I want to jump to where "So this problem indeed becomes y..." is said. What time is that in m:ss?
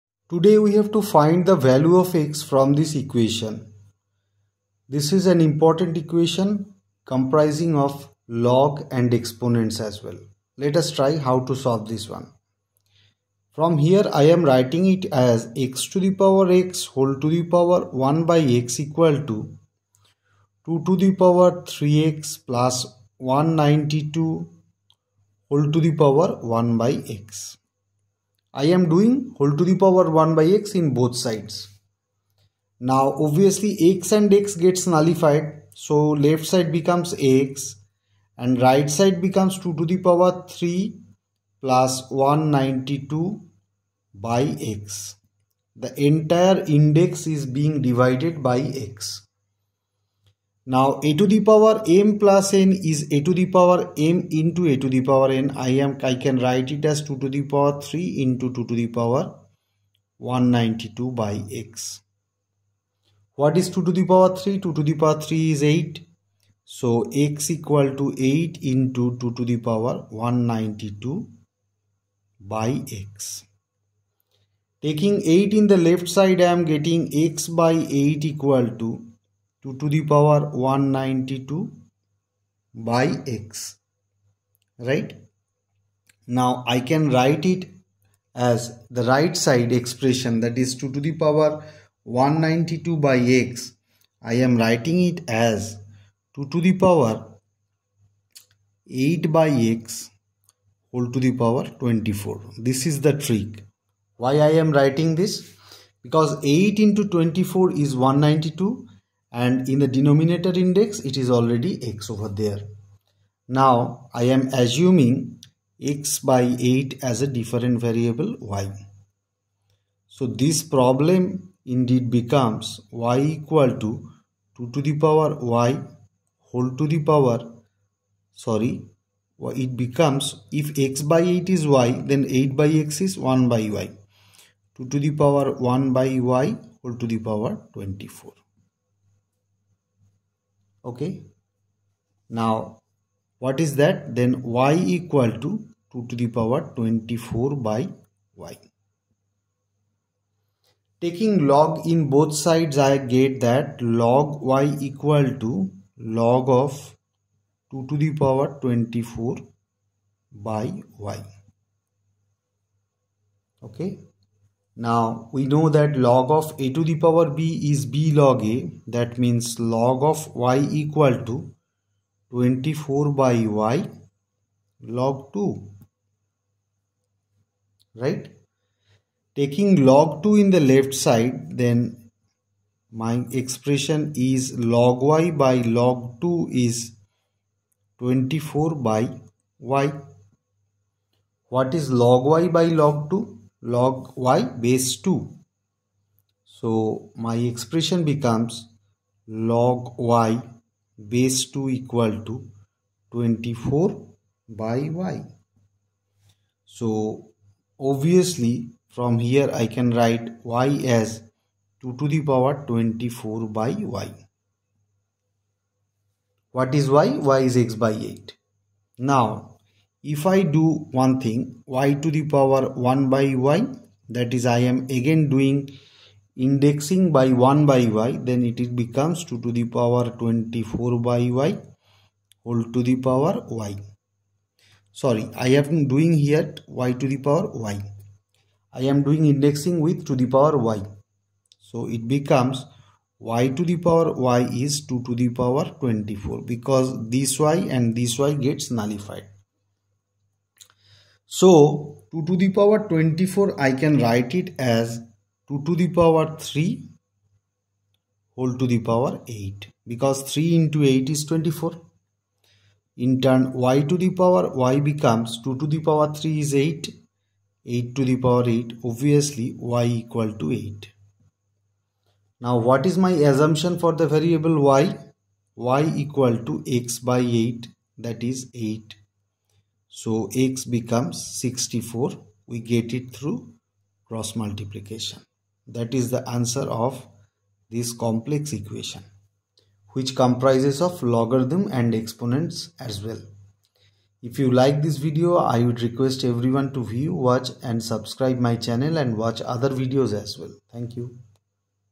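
2:00.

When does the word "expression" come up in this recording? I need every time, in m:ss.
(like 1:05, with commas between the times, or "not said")
1:29, 3:03, 3:17.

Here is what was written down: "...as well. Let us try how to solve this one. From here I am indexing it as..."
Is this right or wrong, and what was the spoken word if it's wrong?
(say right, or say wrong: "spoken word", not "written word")
wrong: "writing", not "indexing".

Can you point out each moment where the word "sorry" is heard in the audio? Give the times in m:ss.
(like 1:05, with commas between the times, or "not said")
2:08, 3:54.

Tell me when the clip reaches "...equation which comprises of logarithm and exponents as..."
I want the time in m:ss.
4:48.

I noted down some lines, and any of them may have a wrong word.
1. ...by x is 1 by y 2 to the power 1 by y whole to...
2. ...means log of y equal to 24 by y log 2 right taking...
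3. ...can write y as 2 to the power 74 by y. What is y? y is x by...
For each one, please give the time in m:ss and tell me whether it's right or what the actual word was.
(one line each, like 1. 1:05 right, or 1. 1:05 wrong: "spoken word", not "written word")
1. 2:12 right
2. 2:49 right
3. 3:29 wrong: "24", not "74".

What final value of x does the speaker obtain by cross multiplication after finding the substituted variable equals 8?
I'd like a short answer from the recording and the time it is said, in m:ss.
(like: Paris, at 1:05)
64, at 4:40.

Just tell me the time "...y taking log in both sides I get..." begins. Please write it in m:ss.
2:28.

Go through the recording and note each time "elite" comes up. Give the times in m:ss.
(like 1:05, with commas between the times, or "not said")
not said.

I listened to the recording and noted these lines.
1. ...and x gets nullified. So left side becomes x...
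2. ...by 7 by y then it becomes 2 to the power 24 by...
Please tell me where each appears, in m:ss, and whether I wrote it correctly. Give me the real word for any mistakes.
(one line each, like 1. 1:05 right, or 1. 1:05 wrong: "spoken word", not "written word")
1. 0:34 right
2. 3:47 wrong: "1", not "7".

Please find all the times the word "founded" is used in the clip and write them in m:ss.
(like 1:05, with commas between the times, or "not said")
not said.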